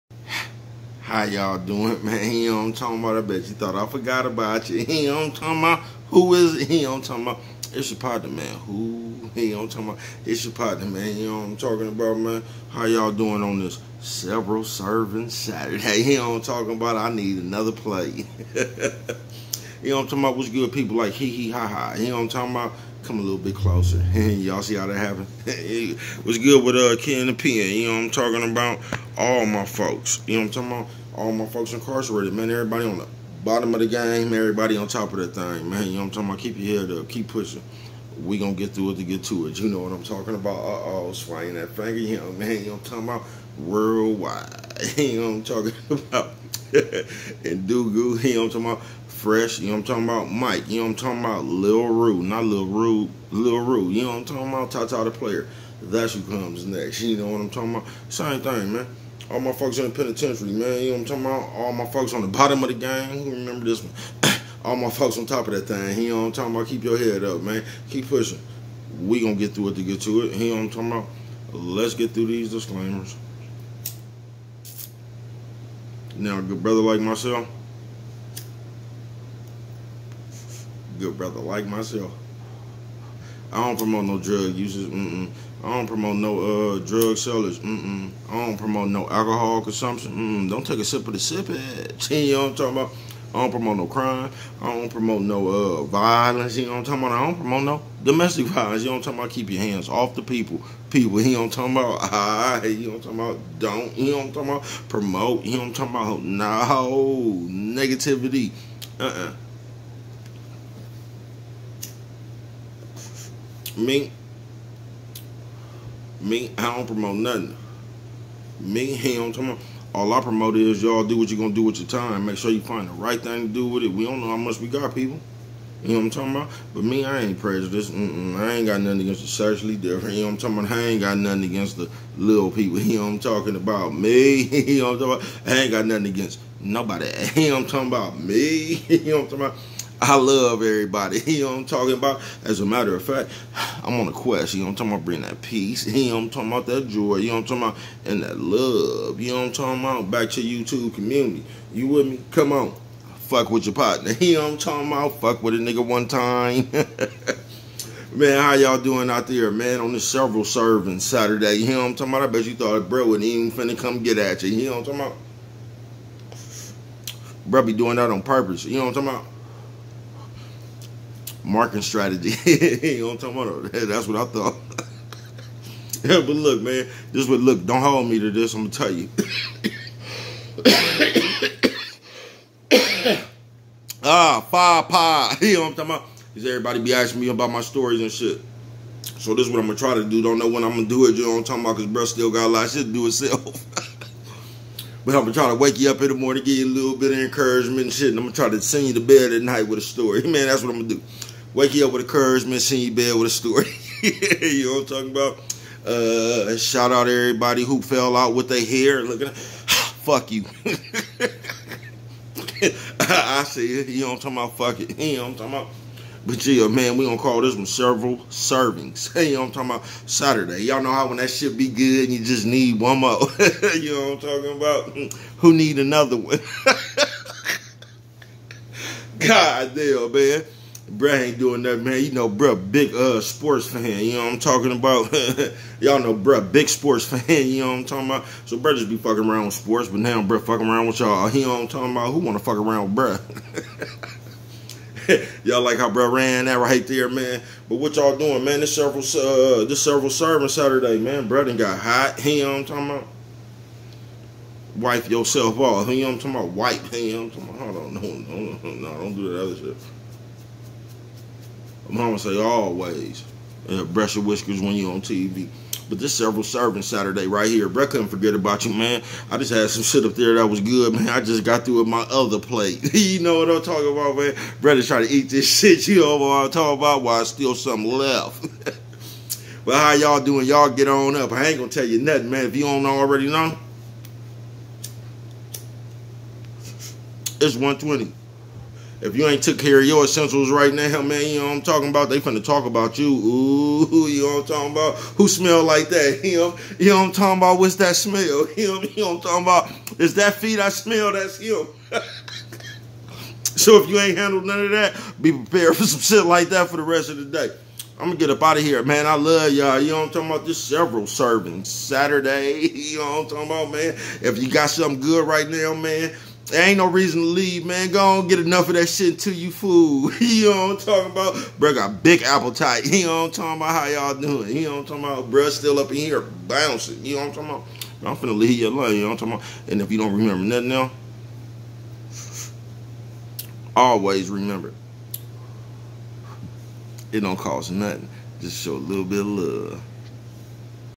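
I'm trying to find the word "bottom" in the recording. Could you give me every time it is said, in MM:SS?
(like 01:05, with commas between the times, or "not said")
00:33, 01:02.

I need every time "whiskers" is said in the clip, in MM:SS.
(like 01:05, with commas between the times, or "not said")
04:24.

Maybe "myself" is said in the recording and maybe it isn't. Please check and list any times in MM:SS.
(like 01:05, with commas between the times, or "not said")
01:16, 01:21.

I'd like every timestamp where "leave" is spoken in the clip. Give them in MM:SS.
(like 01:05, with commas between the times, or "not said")
05:17, 05:28.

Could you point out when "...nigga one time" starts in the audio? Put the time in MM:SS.
02:35.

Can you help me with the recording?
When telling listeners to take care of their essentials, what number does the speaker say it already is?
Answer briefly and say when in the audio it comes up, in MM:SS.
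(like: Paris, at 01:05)
120, at 04:47.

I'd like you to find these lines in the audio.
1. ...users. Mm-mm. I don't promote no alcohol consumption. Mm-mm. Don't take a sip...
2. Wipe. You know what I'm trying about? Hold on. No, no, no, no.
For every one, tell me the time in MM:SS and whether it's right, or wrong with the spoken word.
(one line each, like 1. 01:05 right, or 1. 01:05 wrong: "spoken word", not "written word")
1. 01:27 wrong: "sellers", not "users"
2. 04:16 wrong: "talking", not "trying".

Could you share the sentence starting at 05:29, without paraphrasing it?
And if you don't remember nothing now, always remember it don't cost nothing.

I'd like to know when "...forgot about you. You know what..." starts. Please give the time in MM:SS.
00:03.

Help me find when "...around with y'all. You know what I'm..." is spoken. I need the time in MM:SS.
04:00.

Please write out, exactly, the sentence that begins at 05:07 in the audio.
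I'm gonna get up out of here, man.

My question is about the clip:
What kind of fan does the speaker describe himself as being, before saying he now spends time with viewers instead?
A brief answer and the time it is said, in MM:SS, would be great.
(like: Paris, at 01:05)
sports fan, at 03:56.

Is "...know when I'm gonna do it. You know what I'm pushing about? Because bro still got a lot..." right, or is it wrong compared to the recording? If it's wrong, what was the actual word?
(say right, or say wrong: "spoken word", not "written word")
wrong: "talking", not "pushing".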